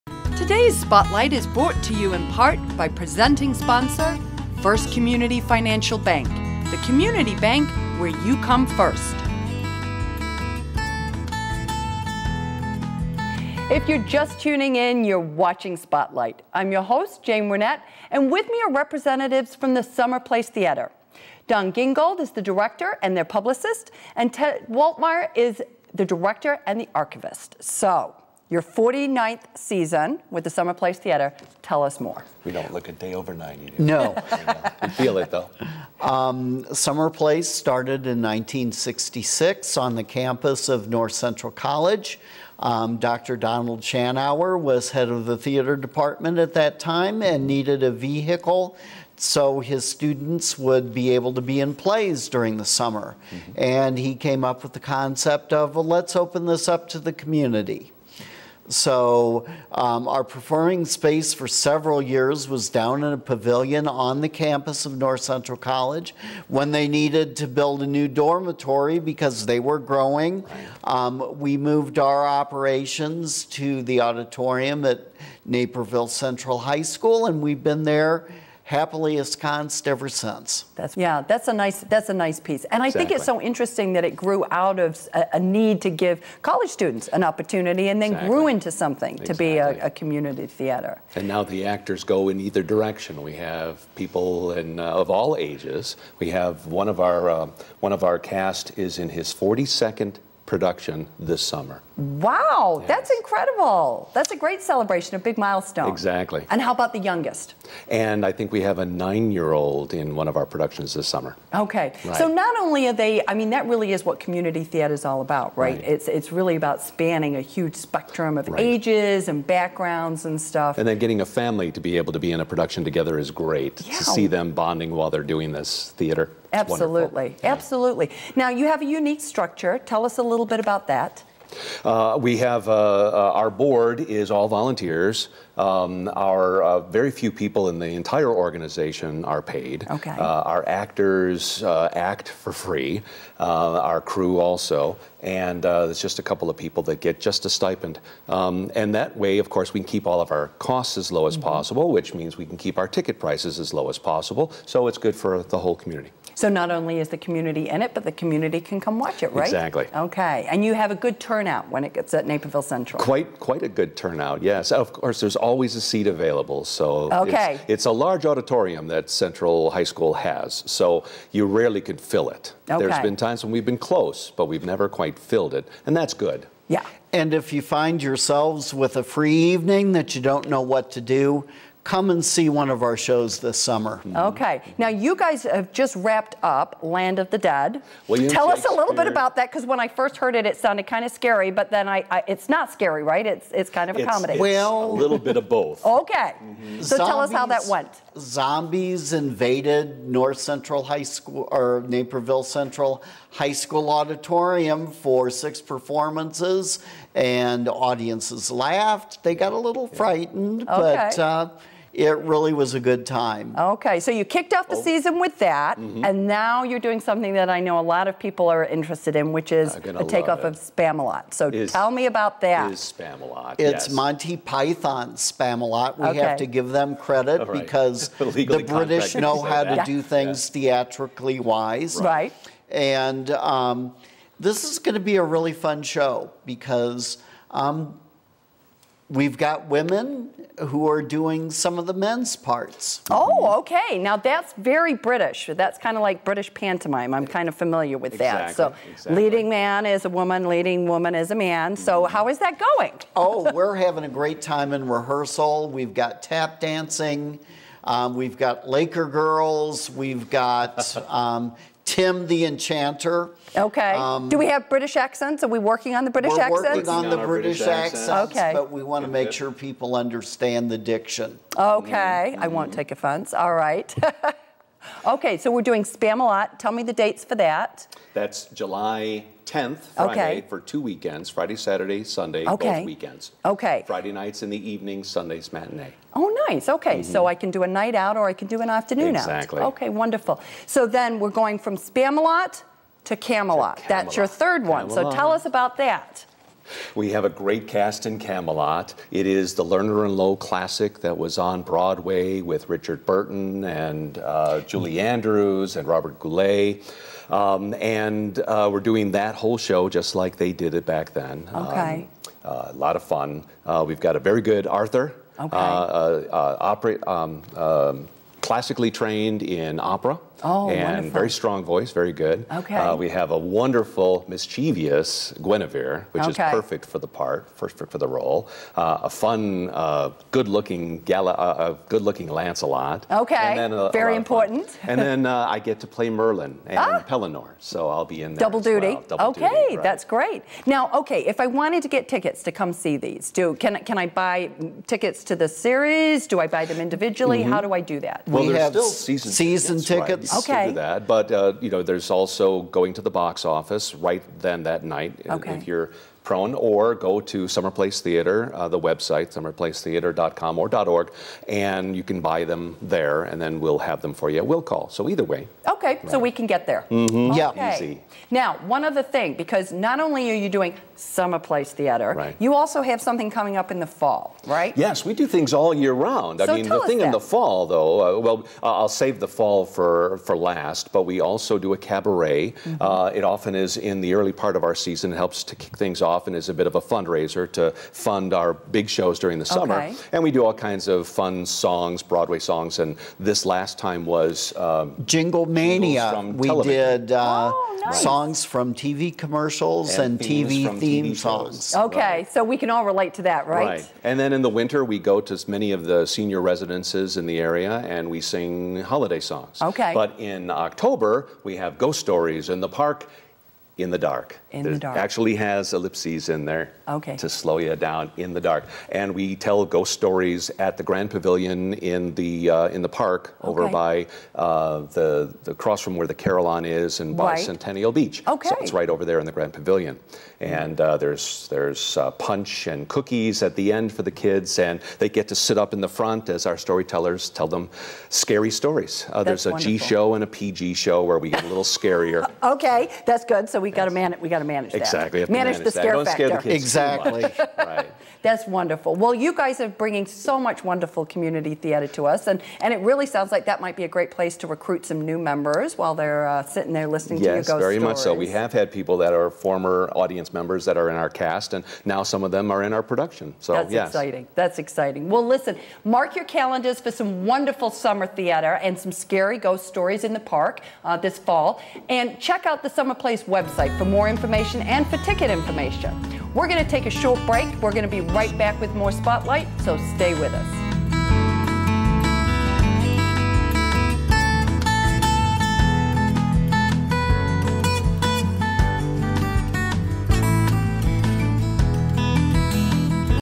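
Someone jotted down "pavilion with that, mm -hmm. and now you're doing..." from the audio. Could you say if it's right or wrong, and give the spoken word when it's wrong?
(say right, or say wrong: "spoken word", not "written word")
wrong: "season", not "pavilion".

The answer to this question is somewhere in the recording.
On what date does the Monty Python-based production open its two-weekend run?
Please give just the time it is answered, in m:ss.
4:38.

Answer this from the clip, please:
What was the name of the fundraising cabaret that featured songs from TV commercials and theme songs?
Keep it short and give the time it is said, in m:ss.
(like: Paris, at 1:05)
Jingle Mania, at 6:35.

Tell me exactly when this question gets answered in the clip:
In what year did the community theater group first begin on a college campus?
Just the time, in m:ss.
0:38.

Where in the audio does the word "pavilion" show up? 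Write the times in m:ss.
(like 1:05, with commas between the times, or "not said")
1:03, 7:01, 7:09.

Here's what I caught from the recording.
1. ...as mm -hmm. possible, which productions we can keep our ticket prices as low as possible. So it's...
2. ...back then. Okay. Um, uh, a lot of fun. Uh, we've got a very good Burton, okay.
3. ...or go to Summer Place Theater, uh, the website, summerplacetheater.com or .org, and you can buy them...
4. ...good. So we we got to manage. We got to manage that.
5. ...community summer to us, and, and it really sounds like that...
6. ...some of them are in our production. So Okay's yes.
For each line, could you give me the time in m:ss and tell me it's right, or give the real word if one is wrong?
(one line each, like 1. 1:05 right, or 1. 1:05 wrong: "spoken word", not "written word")
1. 2:31 wrong: "means", not "productions"
2. 5:10 wrong: "Arthur", not "Burton"
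3. 5:56 right
4. 7:23 right
5. 7:31 wrong: "theater", not "summer"
6. 7:42 wrong: "That", not "Okay".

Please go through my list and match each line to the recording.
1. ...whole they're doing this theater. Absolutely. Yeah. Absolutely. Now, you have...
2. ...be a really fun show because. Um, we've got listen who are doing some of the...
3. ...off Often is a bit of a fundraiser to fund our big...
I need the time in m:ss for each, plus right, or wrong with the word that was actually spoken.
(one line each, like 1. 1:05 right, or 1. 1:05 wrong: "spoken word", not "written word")
1. 2:04 wrong: "while", not "whole"
2. 3:55 wrong: "women", not "listen"
3. 6:26 right.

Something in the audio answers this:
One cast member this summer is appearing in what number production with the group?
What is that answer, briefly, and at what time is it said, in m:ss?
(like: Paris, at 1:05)
42nd, at 1:39.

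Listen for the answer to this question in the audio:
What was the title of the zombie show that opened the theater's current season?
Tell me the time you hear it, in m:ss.
3:06.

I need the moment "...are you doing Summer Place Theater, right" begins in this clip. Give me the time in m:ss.
6:10.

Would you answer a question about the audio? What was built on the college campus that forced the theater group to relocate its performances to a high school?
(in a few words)
a new dormitory.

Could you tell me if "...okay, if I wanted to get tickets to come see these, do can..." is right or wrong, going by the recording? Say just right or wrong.
right.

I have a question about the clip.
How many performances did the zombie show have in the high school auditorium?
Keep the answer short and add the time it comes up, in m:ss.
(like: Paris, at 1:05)
6, at 3:25.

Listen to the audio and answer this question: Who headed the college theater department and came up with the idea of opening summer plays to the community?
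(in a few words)
Dr. Donald Shanauer.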